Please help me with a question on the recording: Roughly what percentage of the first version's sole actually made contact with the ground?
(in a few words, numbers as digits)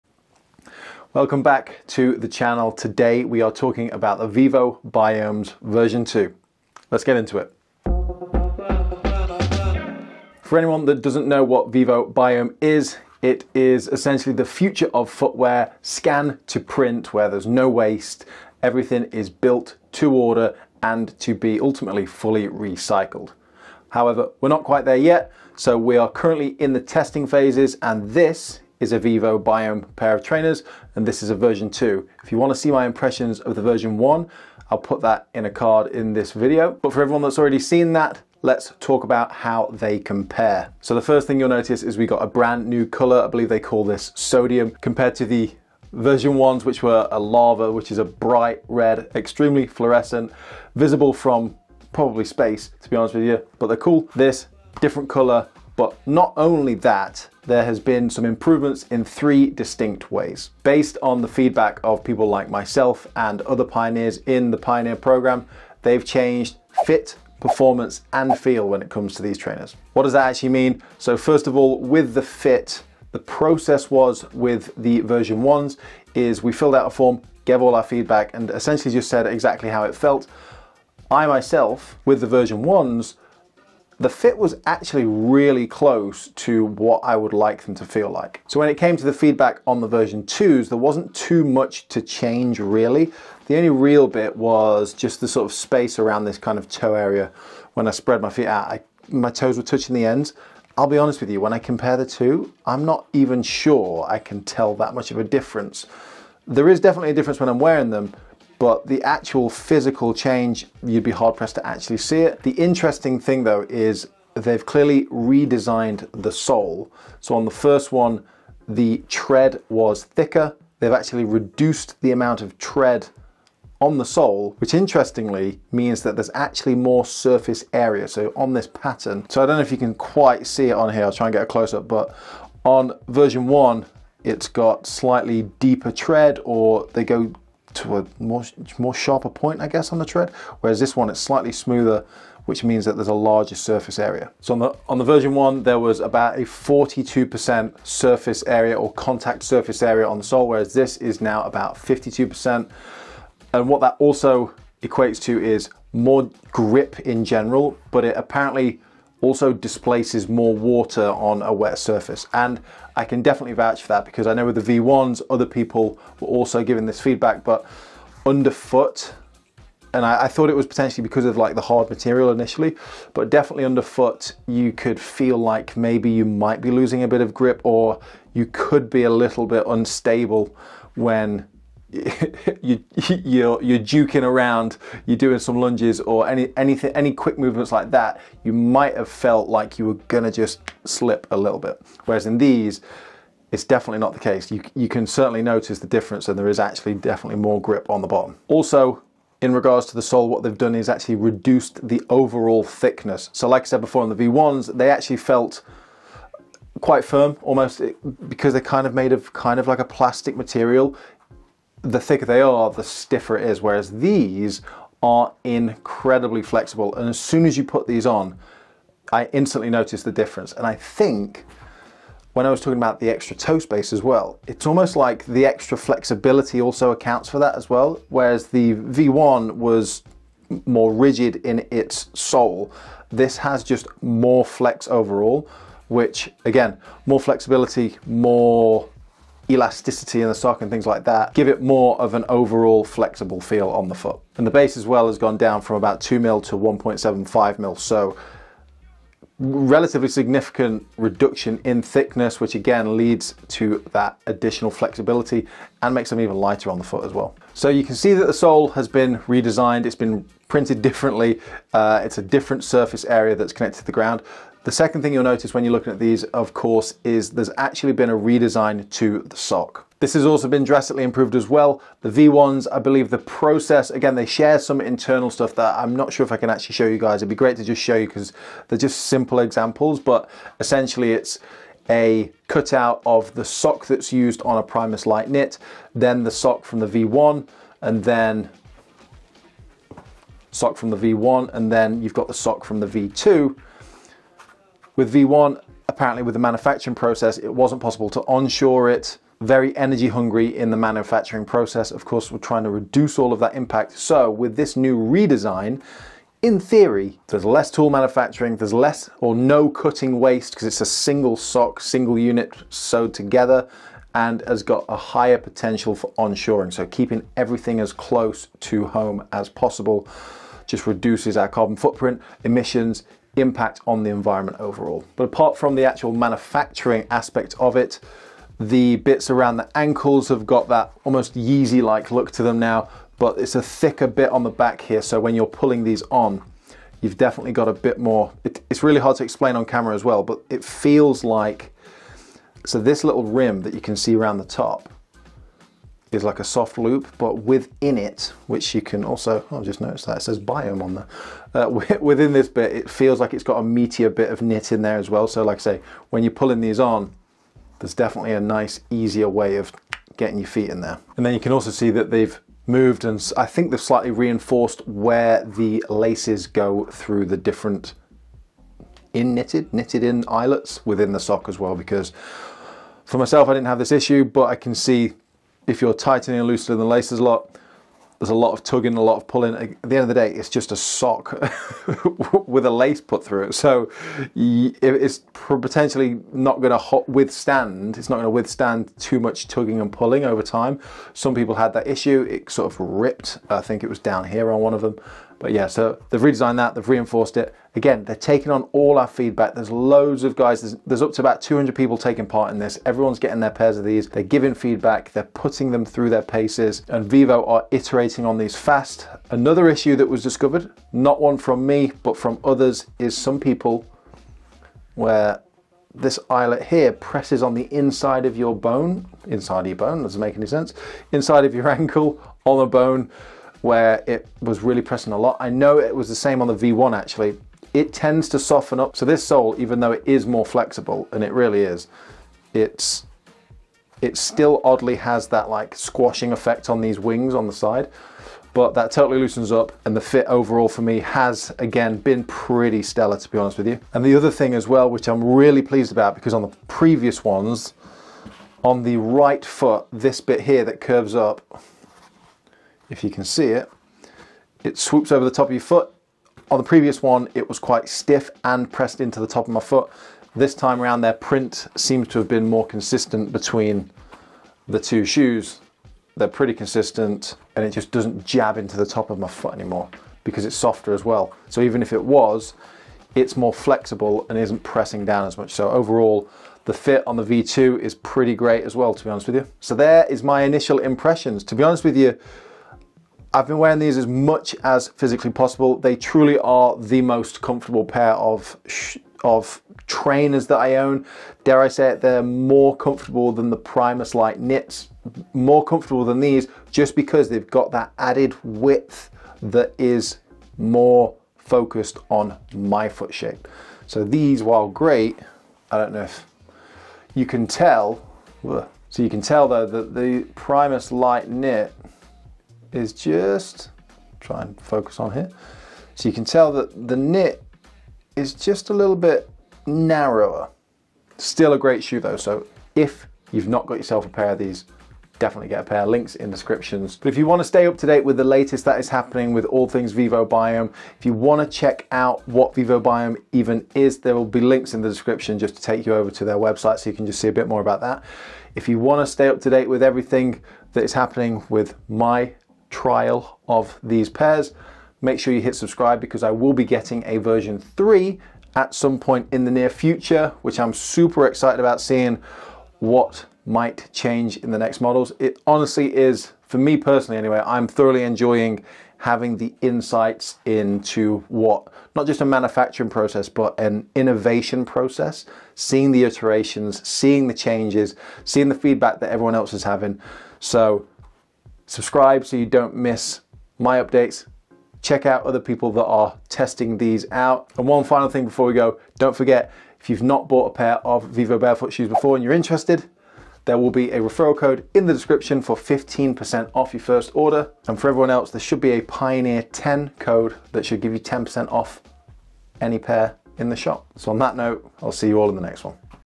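42%.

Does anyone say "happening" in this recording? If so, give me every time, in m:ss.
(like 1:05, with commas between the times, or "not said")
8:48, 9:00.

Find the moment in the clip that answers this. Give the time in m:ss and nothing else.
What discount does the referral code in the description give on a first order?
9:45.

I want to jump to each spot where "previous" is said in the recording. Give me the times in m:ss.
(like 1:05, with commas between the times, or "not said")
7:26, 7:36.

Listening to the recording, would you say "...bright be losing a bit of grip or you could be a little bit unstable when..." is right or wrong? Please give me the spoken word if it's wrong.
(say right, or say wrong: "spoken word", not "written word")
wrong: "might", not "bright".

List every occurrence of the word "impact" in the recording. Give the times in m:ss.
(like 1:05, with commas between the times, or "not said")
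5:03, 5:23.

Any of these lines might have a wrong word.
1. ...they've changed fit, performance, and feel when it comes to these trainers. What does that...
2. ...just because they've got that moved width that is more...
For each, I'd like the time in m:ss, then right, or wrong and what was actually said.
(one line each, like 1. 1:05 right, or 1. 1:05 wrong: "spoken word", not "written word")
1. 1:05 right
2. 8:16 wrong: "added", not "moved".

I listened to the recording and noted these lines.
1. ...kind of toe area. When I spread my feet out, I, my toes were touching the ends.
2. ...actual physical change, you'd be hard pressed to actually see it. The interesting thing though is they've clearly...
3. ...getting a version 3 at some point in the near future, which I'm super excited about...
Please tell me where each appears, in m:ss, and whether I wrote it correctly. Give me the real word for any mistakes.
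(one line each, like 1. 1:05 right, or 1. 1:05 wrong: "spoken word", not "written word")
1. 1:36 right
2. 1:49 right
3. 9:06 right.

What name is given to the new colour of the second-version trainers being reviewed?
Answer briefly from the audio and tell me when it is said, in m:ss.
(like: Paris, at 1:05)
Sodium, at 0:44.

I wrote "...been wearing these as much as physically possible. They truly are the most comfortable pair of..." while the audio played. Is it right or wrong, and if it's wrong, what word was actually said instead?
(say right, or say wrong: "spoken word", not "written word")
right.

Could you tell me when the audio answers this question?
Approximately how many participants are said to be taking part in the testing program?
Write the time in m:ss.
6:41.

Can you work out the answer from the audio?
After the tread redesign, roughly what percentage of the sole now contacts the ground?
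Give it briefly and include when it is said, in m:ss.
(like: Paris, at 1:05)
52%, at 2:31.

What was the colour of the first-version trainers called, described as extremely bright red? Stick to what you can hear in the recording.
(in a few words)
Lava.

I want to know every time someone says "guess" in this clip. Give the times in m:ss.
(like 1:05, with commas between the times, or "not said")
2:19.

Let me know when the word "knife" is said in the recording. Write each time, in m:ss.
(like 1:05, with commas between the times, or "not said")
not said.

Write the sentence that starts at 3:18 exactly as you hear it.
Also, in regards to the sole, what they've done is actually reduced the overall thickness.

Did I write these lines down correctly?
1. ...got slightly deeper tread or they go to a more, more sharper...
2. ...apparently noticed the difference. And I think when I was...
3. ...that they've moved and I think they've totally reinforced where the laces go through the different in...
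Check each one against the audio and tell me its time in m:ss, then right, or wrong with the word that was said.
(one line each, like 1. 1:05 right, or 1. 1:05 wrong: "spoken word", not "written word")
1. 2:14 right
2. 3:39 wrong: "instantly", not "apparently"
3. 6:01 wrong: "slightly", not "totally".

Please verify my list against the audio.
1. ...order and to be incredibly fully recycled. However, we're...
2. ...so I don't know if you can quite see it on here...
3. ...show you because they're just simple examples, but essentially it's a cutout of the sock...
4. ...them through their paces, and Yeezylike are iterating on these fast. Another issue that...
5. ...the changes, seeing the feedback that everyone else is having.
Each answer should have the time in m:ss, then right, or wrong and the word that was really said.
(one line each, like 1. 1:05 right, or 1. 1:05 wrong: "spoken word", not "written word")
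1. 0:20 wrong: "ultimately", not "incredibly"
2. 2:09 right
3. 4:37 right
4. 6:45 wrong: "Vivo", not "Yeezylike"
5. 9:27 right.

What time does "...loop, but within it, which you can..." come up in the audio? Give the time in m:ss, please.
5:46.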